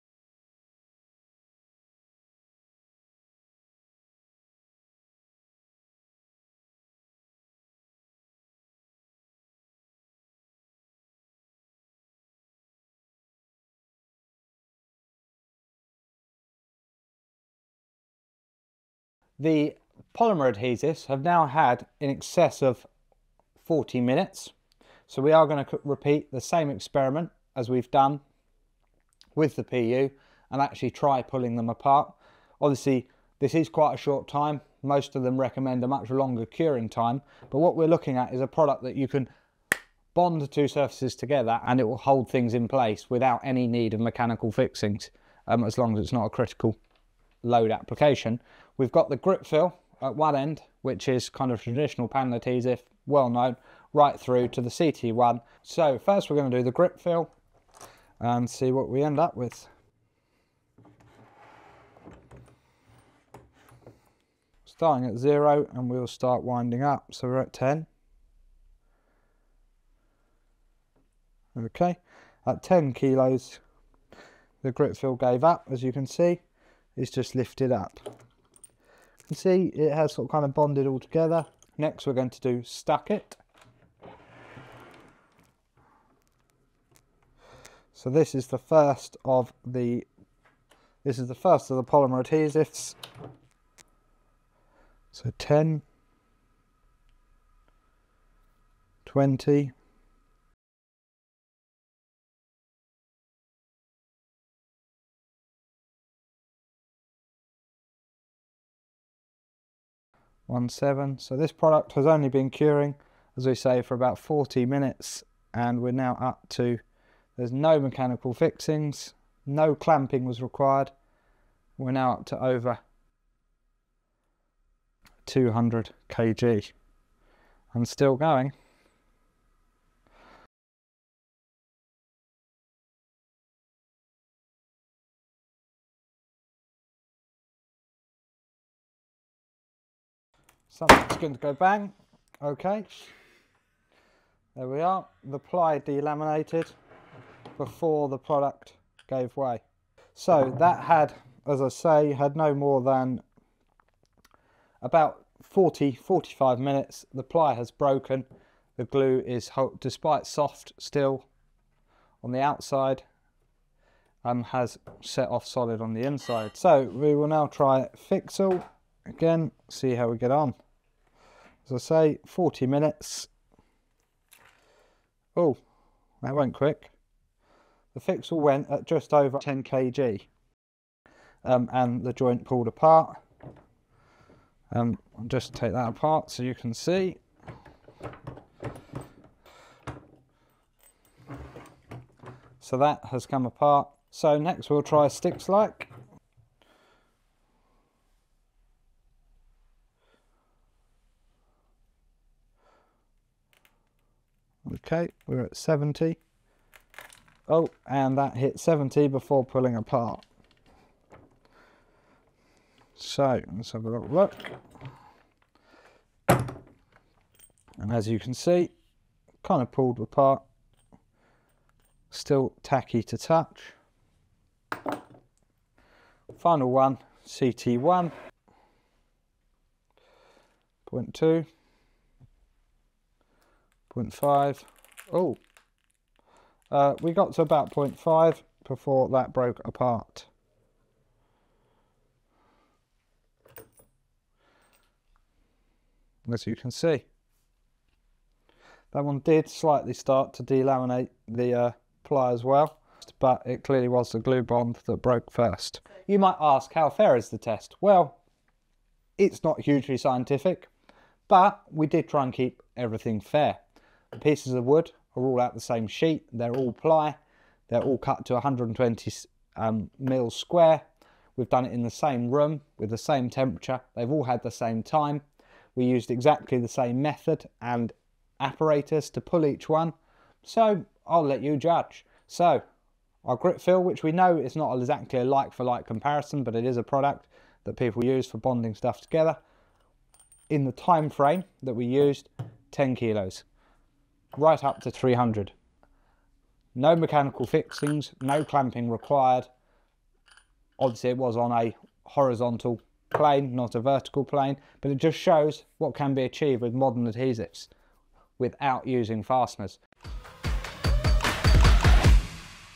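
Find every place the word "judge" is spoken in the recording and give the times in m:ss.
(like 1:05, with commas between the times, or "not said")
4:41.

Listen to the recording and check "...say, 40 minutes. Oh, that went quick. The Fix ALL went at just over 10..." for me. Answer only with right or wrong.
right.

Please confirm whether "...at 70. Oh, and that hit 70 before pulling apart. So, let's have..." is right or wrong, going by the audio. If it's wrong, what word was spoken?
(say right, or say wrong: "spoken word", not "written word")
right.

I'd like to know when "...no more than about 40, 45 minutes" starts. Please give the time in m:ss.
2:32.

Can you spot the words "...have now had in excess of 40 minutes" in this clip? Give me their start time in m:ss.
0:21.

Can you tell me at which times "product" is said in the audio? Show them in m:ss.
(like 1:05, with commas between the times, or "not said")
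0:38, 1:51, 2:28, 4:46.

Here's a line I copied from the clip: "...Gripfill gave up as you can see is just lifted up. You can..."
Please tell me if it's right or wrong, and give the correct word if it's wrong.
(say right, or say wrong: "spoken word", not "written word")
right.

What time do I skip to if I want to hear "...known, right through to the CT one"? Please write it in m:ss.
0:53.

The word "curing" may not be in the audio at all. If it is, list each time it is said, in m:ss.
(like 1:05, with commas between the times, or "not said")
0:36, 1:52.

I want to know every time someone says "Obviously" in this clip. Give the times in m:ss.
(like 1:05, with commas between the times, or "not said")
0:32, 5:00.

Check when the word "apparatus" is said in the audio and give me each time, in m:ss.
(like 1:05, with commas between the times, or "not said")
4:38.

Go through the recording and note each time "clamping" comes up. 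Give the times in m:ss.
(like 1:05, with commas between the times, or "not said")
1:59, 4:58.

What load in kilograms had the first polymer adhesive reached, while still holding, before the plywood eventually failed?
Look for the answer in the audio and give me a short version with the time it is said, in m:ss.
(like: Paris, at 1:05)
200 kg, at 2:02.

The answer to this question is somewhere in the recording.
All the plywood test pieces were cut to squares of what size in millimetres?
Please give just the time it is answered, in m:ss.
4:28.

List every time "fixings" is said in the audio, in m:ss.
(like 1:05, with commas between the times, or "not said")
0:44, 1:58, 4:57.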